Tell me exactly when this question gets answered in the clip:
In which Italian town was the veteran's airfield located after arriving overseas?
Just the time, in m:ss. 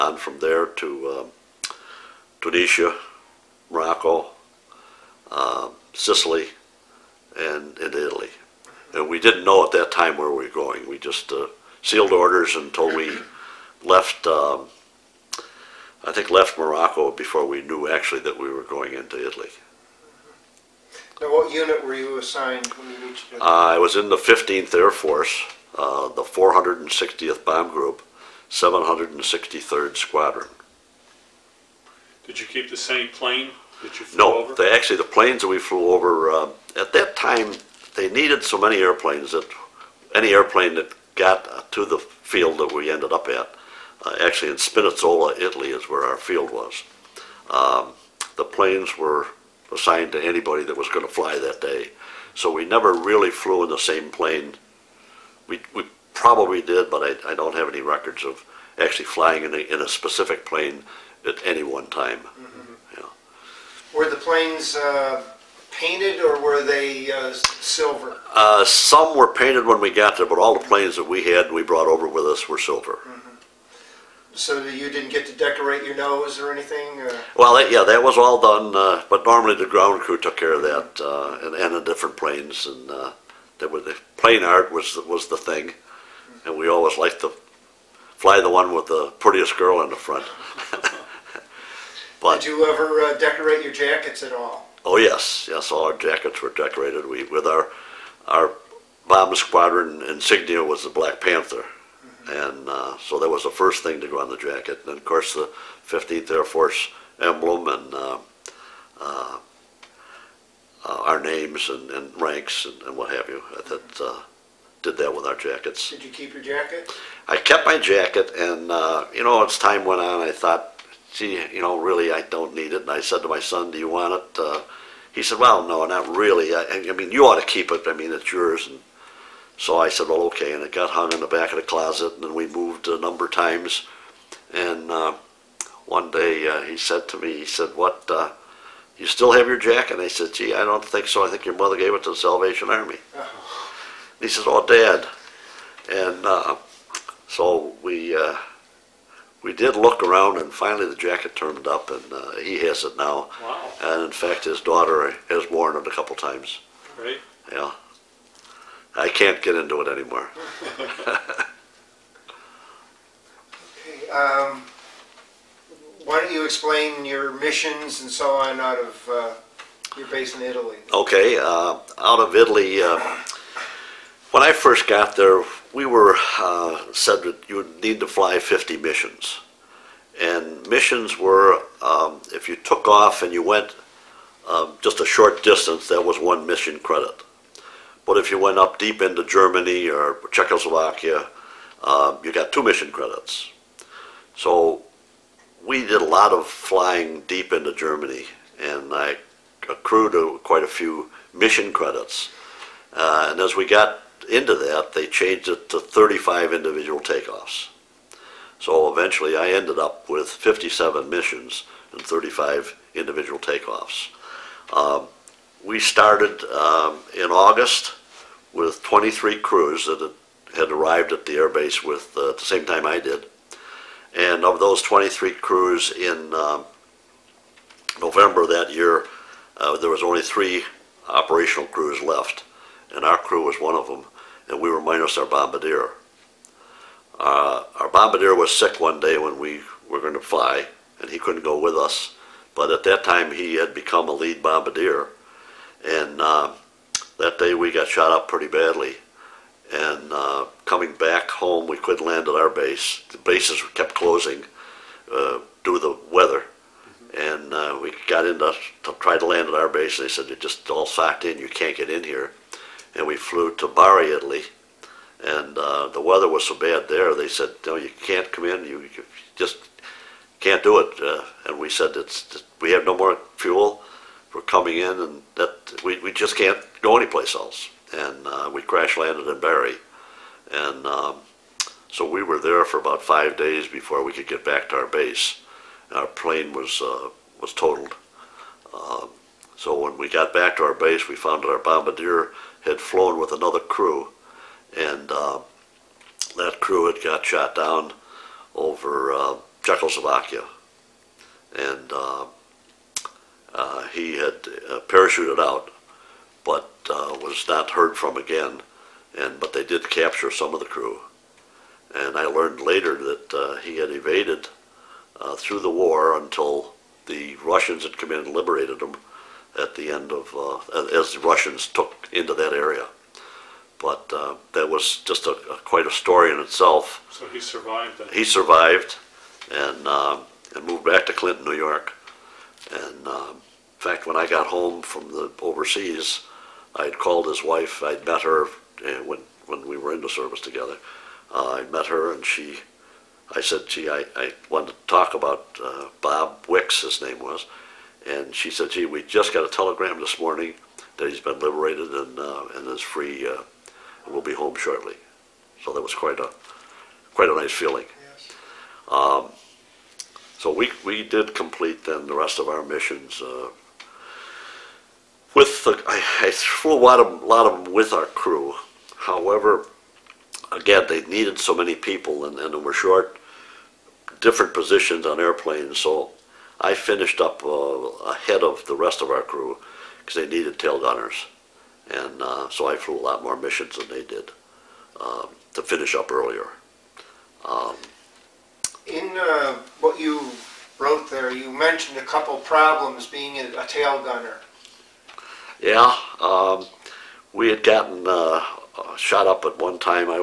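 0:44.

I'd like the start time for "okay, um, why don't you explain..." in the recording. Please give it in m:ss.
2:43.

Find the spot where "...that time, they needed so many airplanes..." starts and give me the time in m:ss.
0:36.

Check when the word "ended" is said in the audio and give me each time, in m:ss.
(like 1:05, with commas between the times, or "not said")
0:42, 3:29.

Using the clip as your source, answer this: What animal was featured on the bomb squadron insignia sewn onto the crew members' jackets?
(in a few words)
Black Panther.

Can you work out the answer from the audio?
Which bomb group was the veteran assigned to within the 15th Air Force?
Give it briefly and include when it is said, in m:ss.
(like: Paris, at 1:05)
460th Bomb Group, at 0:26.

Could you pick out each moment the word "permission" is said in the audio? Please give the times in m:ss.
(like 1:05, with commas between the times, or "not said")
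not said.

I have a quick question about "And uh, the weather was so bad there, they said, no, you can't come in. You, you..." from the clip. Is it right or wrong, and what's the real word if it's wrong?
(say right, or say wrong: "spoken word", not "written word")
right.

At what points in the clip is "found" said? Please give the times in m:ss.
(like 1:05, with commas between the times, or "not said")
4:51.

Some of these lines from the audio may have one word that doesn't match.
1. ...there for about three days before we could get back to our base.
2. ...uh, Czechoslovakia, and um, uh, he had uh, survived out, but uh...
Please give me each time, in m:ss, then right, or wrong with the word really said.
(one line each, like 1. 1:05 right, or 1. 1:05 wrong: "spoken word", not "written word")
1. 4:42 wrong: "five", not "three"
2. 4:59 wrong: "parachuted", not "survived".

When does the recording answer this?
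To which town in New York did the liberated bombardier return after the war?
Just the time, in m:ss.
5:31.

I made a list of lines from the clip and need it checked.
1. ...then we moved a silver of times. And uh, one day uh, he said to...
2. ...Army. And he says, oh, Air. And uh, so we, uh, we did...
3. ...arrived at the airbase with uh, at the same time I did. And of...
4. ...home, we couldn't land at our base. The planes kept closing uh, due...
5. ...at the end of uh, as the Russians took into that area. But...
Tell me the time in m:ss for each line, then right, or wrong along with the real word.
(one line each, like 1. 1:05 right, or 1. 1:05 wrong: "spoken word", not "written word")
1. 2:12 wrong: "number", not "silver"
2. 2:22 wrong: "Dad", not "Air"
3. 3:40 right
4. 4:11 wrong: "bases", not "planes"
5. 5:19 right.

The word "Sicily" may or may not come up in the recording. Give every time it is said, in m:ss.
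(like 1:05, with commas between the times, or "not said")
0:05.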